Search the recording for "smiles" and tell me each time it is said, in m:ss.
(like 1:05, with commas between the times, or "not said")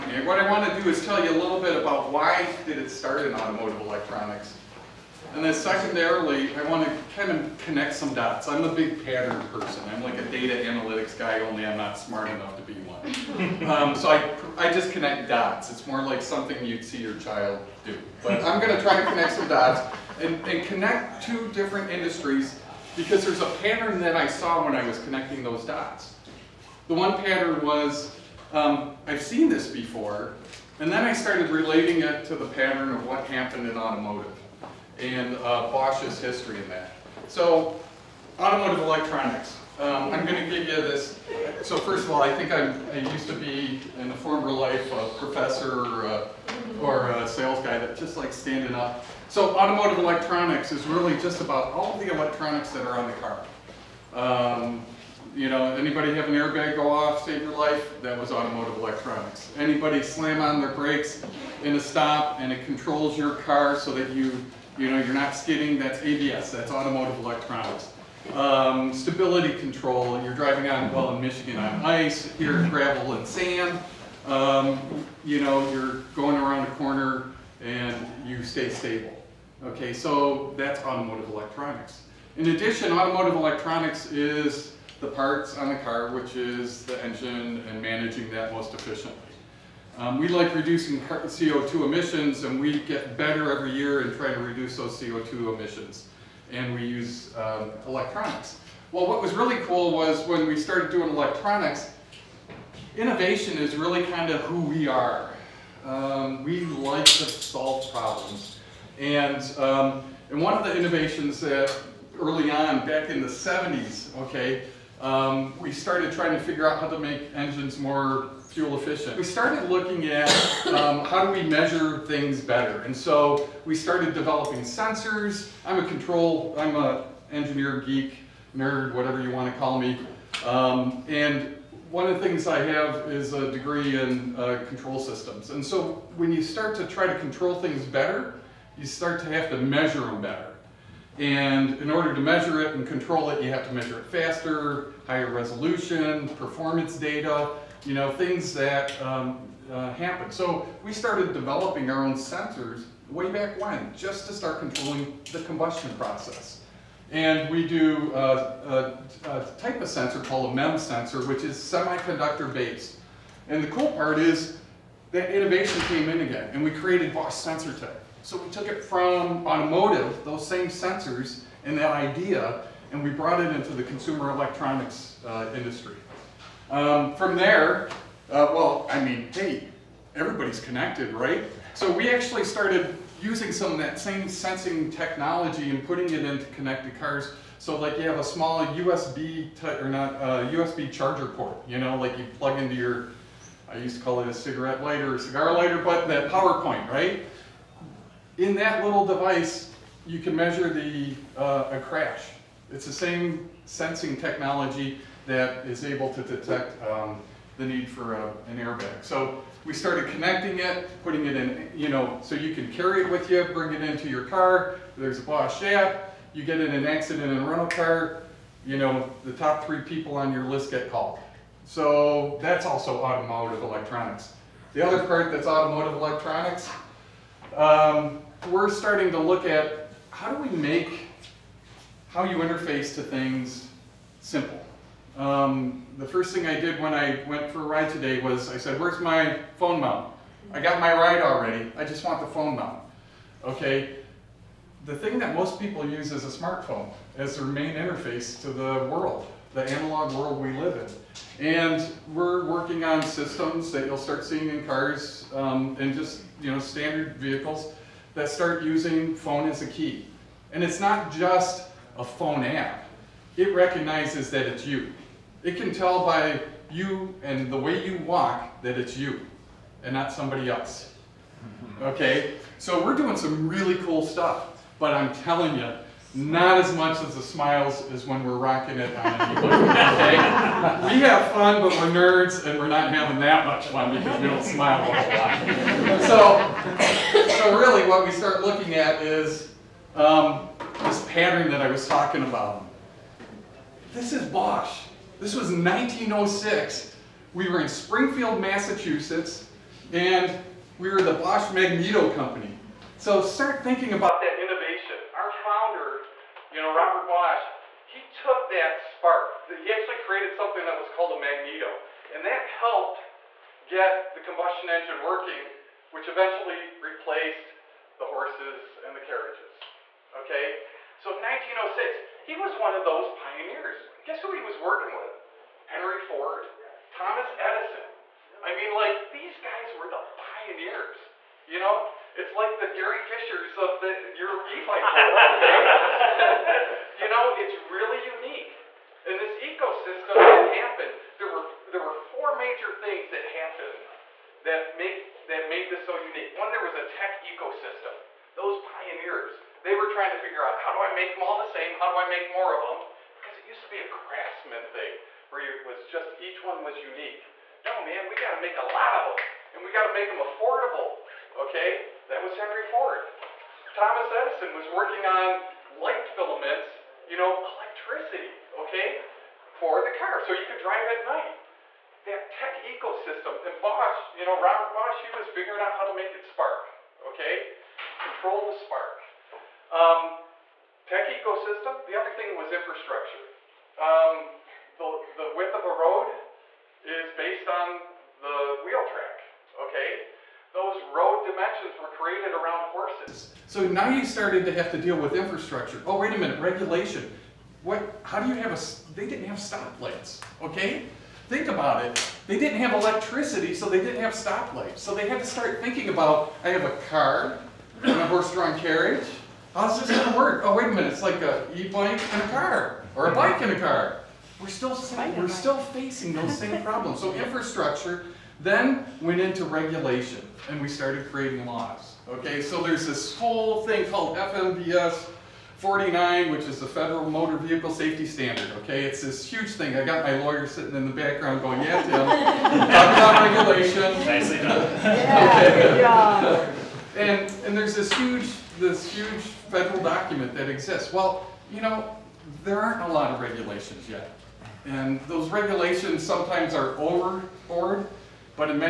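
4:37, 4:44.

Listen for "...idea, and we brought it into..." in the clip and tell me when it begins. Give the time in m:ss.
2:51.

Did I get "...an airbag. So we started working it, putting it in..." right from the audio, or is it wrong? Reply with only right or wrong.
wrong.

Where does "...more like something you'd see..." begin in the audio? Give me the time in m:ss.
0:15.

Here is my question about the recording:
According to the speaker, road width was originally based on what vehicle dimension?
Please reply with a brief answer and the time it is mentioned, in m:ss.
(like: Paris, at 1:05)
Wheel track, at 6:28.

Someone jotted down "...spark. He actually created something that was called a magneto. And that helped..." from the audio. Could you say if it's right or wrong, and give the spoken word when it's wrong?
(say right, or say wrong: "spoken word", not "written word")
right.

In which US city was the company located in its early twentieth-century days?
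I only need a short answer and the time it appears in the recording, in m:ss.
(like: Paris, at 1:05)
Springfield, Massachusetts, at 4:57.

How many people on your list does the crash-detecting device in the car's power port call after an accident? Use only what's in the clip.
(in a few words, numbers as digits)
3.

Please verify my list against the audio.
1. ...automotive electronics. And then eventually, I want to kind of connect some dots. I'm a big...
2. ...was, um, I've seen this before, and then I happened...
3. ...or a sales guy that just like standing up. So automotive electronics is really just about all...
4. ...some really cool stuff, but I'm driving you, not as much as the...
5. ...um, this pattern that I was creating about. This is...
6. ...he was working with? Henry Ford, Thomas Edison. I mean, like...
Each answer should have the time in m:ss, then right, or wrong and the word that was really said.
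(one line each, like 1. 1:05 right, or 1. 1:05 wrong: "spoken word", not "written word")
1. 0:03 wrong: "secondarily", not "eventually"
2. 0:27 wrong: "started", not "happened"
3. 0:46 right
4. 4:33 wrong: "telling", not "driving"
5. 4:49 wrong: "talking", not "creating"
6. 5:24 right.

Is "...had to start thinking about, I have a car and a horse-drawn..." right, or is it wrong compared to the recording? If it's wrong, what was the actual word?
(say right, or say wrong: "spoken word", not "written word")
right.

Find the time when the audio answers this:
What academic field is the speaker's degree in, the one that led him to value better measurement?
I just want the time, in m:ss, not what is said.
2:14.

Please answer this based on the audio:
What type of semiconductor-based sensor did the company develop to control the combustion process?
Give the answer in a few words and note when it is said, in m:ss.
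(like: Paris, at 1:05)
MEMS sensor, at 2:40.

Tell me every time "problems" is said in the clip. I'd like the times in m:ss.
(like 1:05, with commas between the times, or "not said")
1:47, 6:56.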